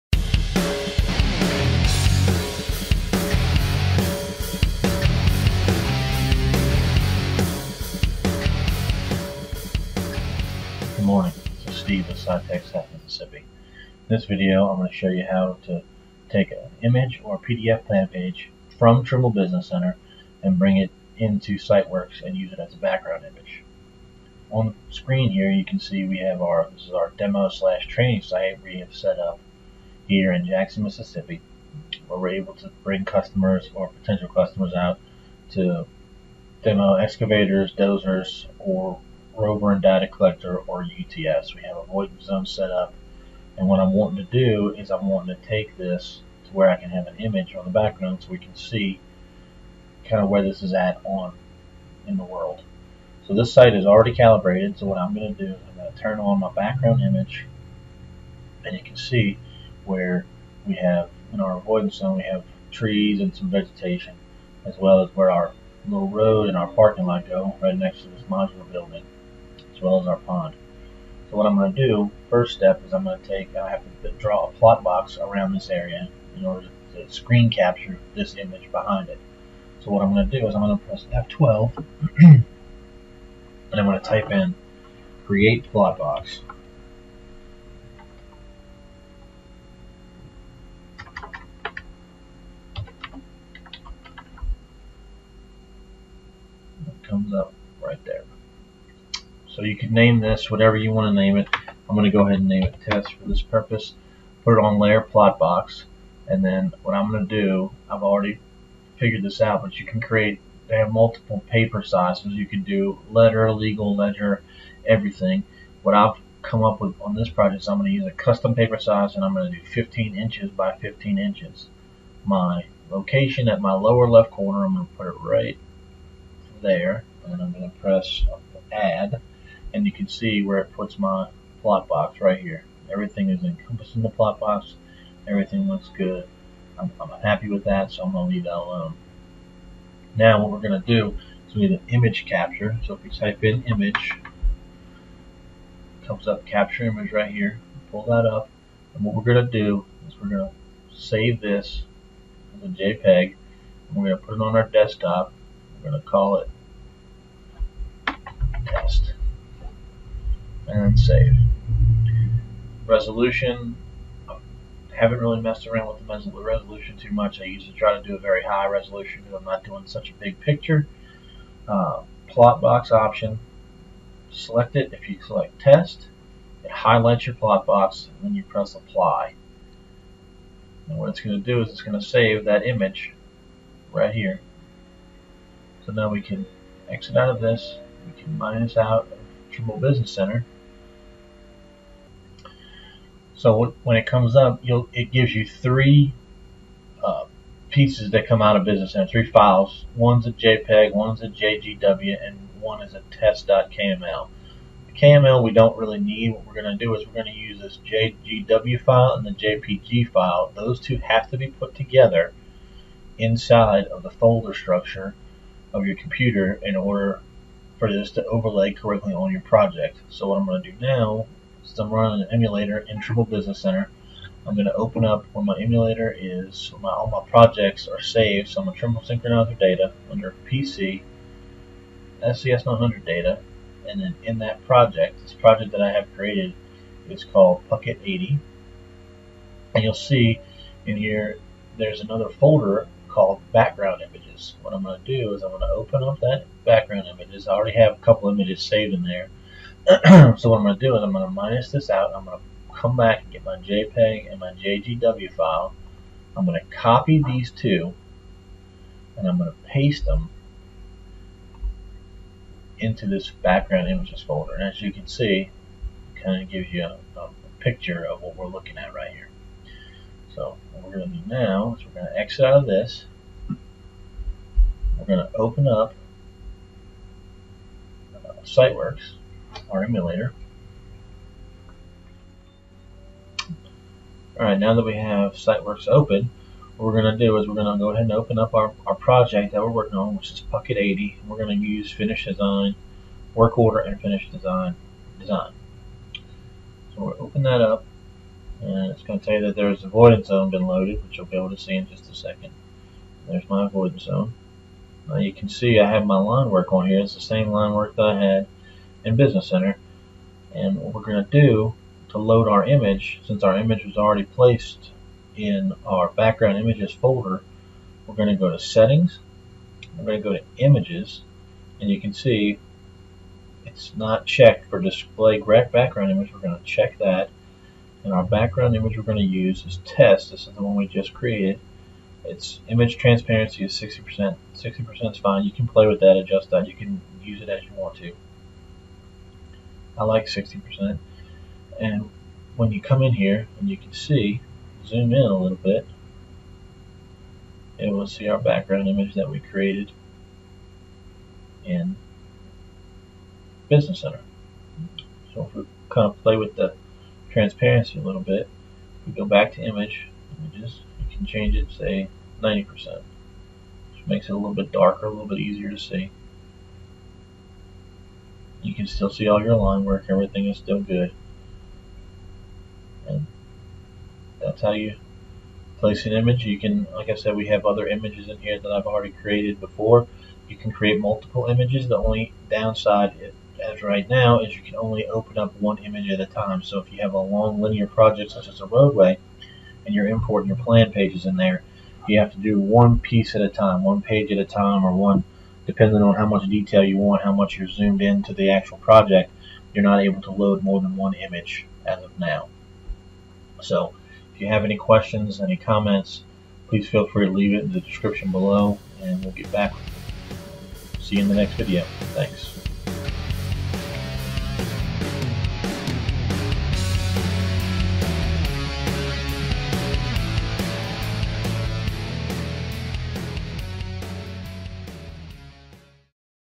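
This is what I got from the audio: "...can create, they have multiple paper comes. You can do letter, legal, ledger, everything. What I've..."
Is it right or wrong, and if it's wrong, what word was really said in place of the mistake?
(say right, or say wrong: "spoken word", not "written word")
wrong: "sizes", not "comes".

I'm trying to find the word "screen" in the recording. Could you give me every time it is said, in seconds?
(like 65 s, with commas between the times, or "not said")
24 s, 77 s.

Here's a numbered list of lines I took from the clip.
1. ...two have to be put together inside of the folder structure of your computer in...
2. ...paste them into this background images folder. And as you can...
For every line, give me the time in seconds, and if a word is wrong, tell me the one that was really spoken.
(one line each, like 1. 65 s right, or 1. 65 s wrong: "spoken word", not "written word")
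1. 210 s right
2. 259 s right.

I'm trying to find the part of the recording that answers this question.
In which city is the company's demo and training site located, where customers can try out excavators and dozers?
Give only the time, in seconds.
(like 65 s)
30 s.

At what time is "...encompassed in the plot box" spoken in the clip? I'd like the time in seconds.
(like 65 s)
133 s.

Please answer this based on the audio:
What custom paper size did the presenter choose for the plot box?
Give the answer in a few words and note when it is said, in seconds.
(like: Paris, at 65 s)
15 inches by 15 inches, at 119 s.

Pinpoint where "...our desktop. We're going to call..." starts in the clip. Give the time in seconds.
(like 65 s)
154 s.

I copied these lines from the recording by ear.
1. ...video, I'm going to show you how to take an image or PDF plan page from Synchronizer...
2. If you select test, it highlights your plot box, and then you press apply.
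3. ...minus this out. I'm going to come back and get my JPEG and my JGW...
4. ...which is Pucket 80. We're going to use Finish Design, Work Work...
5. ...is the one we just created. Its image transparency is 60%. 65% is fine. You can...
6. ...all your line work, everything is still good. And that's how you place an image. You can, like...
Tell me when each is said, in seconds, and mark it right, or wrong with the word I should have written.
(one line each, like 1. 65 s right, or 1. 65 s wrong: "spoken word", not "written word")
1. 14 s wrong: "Trimble", not "Synchronizer"
2. 174 s right
3. 251 s right
4. 290 s wrong: "Order", not "Work"
5. 330 s wrong: "60", not "65"
6. 369 s right.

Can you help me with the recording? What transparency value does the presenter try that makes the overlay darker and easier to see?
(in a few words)
90%.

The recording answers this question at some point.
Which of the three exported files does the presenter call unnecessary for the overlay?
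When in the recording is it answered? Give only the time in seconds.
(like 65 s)
204 s.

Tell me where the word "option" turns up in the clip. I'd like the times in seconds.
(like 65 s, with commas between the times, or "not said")
172 s.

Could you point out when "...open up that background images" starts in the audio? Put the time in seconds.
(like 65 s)
245 s.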